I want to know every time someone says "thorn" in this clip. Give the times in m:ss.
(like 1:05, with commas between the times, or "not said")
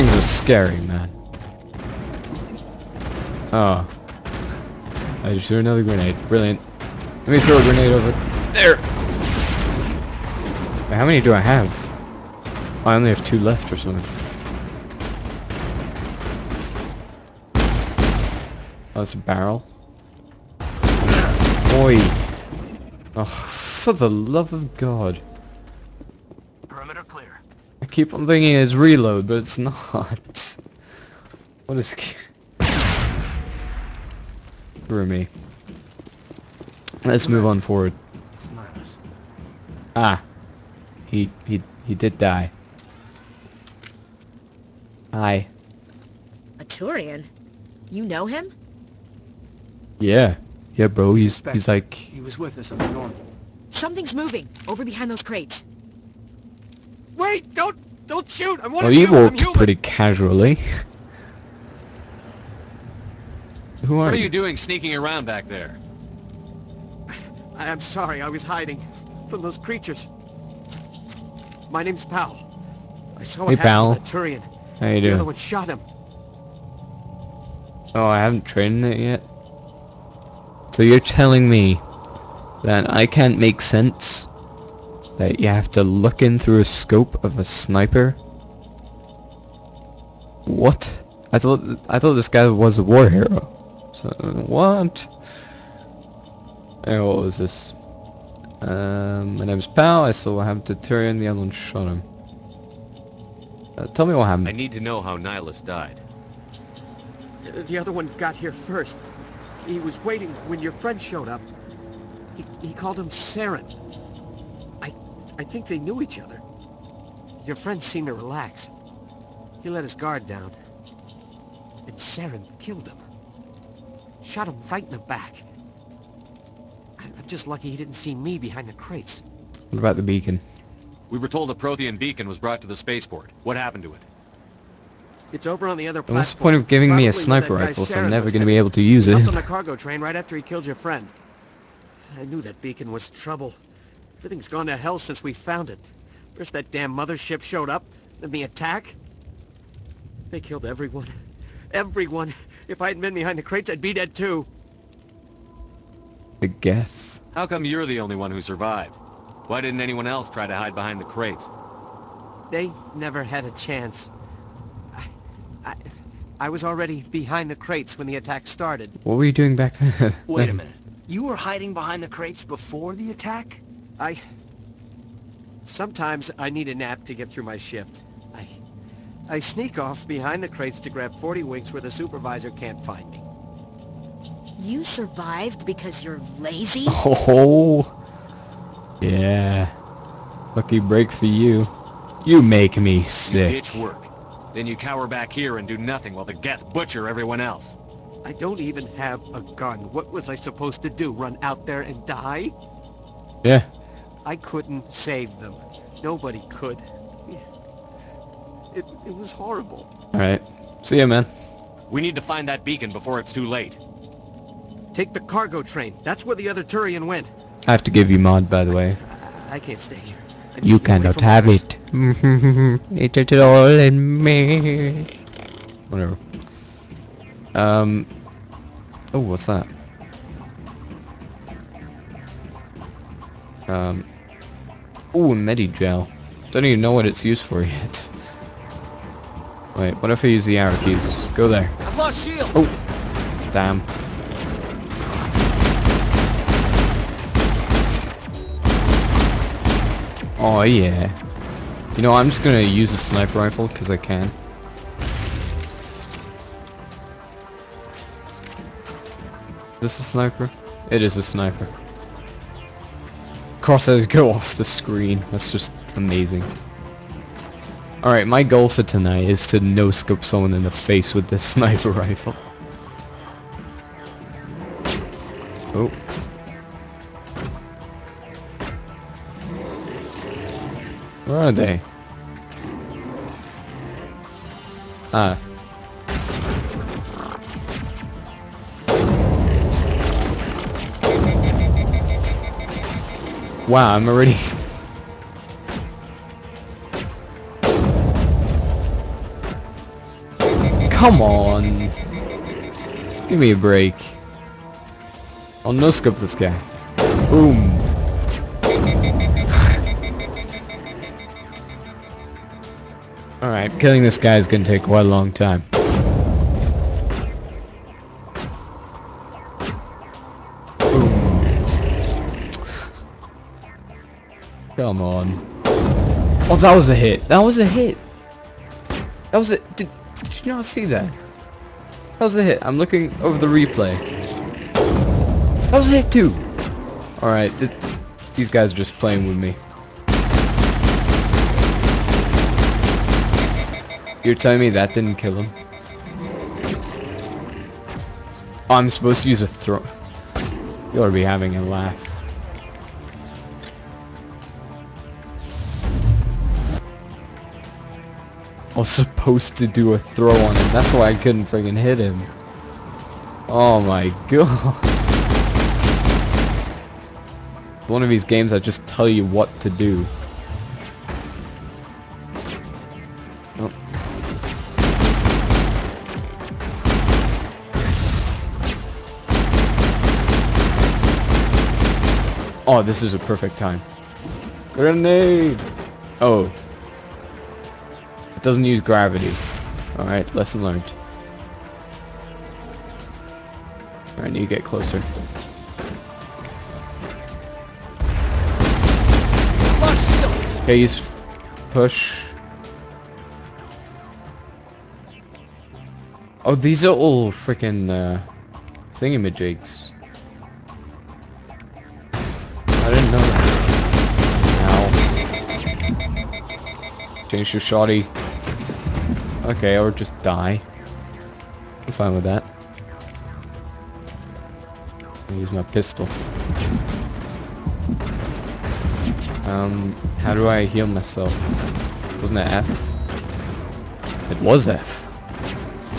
not said.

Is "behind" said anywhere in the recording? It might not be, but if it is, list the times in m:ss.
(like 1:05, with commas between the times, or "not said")
0:54, 2:08, 2:33, 2:40, 2:47, 2:51, 3:00.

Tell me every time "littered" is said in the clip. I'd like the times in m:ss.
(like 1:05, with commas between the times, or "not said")
not said.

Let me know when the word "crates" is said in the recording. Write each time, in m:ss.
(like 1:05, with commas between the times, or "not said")
0:55, 2:08, 2:33, 2:41, 2:47, 2:52, 3:00.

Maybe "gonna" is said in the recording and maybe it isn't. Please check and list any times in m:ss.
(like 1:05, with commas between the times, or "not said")
4:12, 5:14.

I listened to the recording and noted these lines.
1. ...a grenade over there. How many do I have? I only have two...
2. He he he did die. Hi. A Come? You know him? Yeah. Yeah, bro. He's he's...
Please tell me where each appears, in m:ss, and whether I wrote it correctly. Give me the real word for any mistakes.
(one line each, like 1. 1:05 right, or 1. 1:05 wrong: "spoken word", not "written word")
1. 0:07 right
2. 0:41 wrong: "Turian", not "Come".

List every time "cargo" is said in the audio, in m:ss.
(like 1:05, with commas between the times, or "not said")
2:19, 3:35.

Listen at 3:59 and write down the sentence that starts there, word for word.
Wait, what if I use the arrow keys?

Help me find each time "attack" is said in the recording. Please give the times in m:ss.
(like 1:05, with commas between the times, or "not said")
2:28, 2:48, 2:53.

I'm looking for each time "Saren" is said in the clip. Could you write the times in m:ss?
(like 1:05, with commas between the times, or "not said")
1:53, 2:01.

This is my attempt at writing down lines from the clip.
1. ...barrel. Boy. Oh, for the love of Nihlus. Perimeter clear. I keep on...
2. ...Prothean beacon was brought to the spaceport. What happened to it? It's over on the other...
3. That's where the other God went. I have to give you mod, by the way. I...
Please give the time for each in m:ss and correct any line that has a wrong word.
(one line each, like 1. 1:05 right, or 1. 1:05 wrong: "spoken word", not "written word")
1. 0:19 wrong: "God", not "Nihlus"
2. 2:11 right
3. 3:36 wrong: "Turian", not "God".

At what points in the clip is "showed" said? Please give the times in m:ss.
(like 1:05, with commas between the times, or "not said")
1:50, 2:27.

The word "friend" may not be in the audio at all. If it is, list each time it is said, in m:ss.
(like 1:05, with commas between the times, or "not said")
1:50, 1:57, 2:20.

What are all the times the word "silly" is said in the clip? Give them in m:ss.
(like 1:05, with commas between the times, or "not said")
not said.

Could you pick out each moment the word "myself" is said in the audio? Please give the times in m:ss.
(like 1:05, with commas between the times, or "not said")
7:10.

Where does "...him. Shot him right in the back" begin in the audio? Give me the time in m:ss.
2:02.